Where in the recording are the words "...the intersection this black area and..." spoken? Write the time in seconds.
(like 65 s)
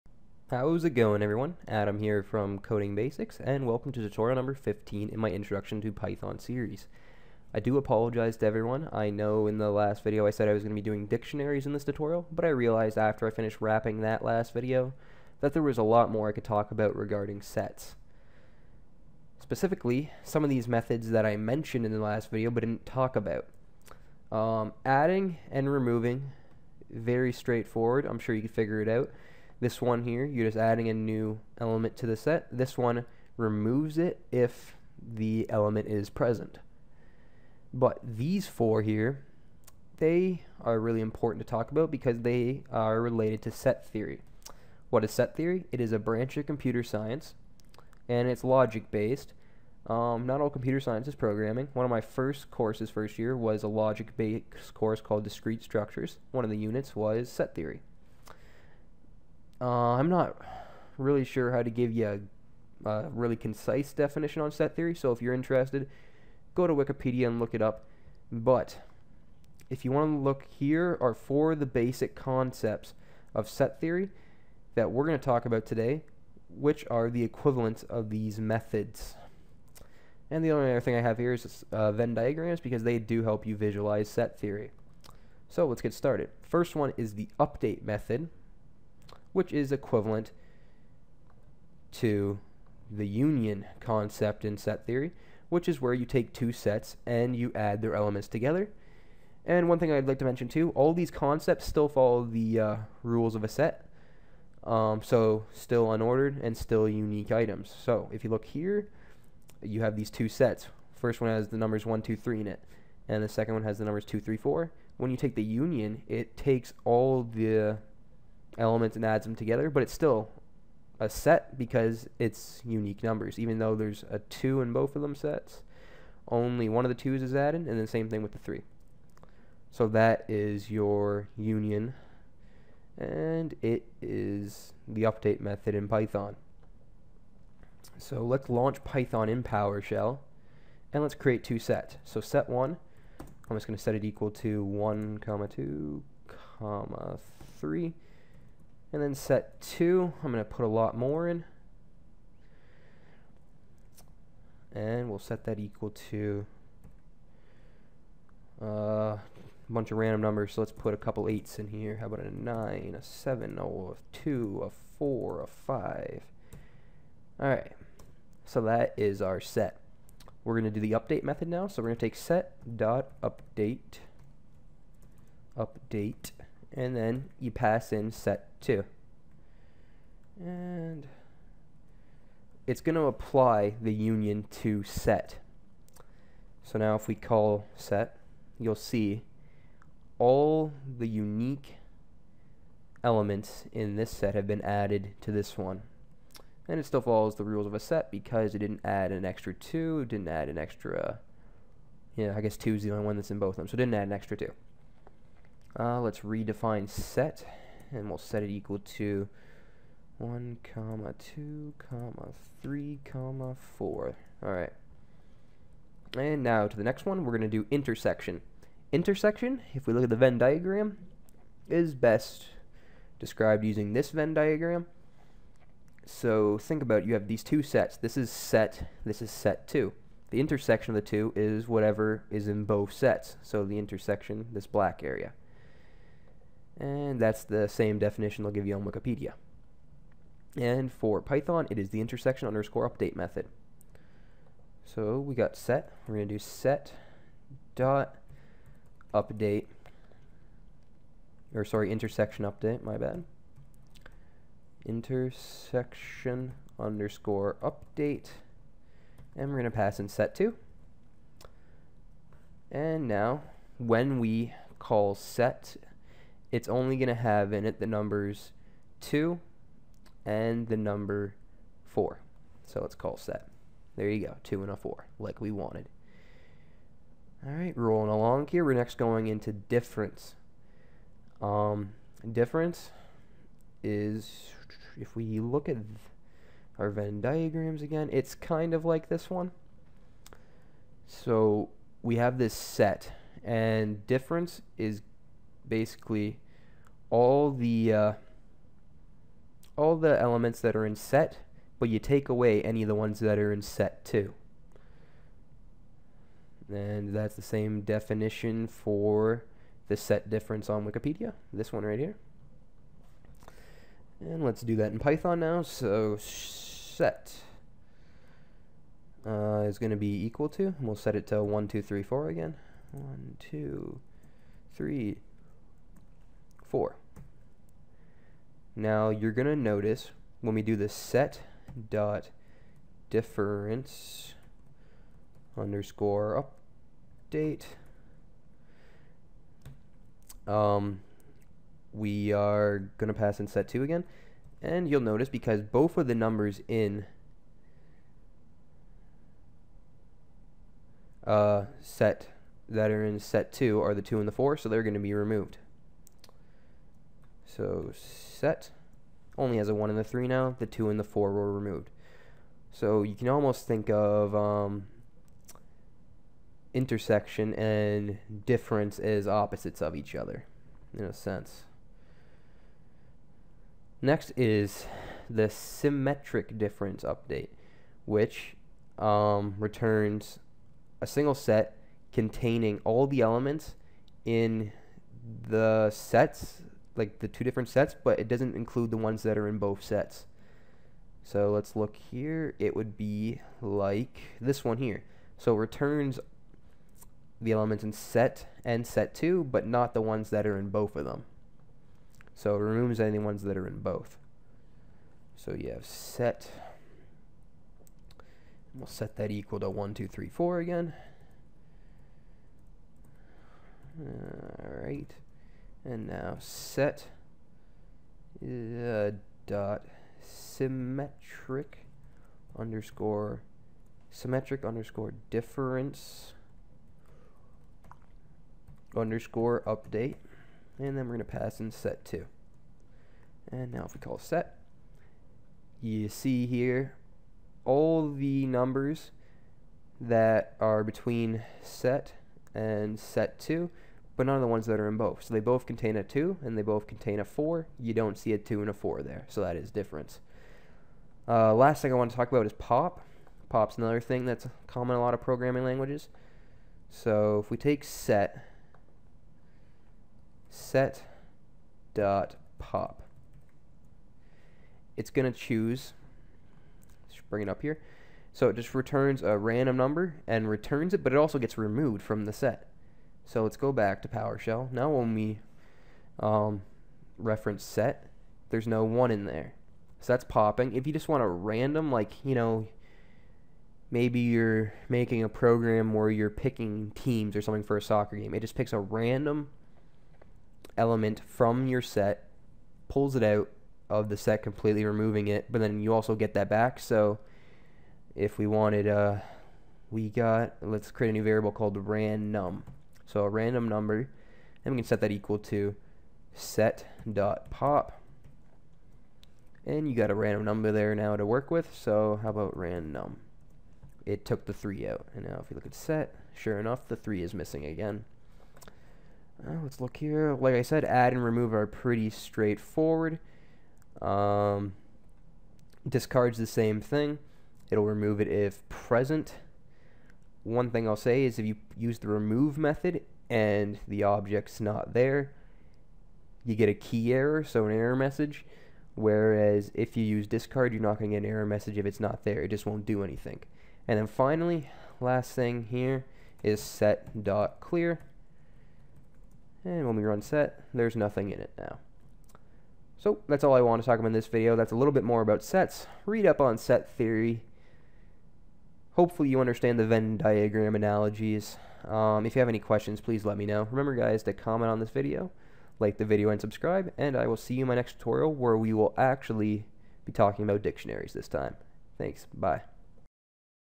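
233 s.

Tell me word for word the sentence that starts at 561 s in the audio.
Um, if you have any questions, please let me know.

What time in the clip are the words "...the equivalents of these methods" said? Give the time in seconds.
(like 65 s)
77 s.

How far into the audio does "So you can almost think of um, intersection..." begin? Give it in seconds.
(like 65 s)
362 s.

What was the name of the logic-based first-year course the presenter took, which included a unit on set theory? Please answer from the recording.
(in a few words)
Discrete Structures.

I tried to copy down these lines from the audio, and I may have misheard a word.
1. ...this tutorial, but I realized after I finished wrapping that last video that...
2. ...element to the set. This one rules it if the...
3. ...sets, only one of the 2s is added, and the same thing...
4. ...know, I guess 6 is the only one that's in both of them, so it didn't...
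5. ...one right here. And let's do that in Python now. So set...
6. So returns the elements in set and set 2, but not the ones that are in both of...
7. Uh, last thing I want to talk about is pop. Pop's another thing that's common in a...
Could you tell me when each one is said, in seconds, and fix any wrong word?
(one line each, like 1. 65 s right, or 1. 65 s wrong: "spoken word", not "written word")
1. 11 s right
2. 31 s wrong: "removes", not "rules"
3. 125 s right
4. 202 s wrong: "2", not "6"
5. 311 s right
6. 395 s right
7. 451 s right.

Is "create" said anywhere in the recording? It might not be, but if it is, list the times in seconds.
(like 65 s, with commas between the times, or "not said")
141 s, 500 s.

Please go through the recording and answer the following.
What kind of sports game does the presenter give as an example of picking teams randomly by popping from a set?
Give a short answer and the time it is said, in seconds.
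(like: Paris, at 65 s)
Soccer, at 487 s.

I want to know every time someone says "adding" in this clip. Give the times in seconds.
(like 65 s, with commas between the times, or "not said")
24 s, 30 s.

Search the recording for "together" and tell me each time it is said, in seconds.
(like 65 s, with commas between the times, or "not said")
98 s, 119 s.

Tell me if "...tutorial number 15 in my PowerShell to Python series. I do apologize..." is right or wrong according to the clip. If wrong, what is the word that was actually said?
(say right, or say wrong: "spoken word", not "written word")
wrong: "Introduction", not "PowerShell".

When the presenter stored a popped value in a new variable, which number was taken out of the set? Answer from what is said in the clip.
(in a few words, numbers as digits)
3.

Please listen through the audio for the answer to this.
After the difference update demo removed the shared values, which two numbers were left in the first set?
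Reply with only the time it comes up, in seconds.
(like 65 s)
359 s.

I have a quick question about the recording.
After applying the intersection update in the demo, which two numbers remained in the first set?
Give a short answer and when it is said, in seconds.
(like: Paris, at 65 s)
2 and 4, at 269 s.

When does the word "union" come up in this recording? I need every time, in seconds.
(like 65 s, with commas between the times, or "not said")
93 s, 115 s, 131 s, 183 s.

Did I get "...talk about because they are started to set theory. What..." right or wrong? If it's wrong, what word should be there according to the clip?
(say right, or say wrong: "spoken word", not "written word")
wrong: "related", not "started".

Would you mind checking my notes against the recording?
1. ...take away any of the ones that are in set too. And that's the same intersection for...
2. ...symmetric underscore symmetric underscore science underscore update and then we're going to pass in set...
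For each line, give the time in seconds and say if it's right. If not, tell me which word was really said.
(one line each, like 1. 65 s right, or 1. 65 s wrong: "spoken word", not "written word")
1. 301 s wrong: "definition", not "intersection"
2. 420 s wrong: "difference", not "science".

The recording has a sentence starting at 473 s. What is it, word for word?
So let's go back to PowerShell.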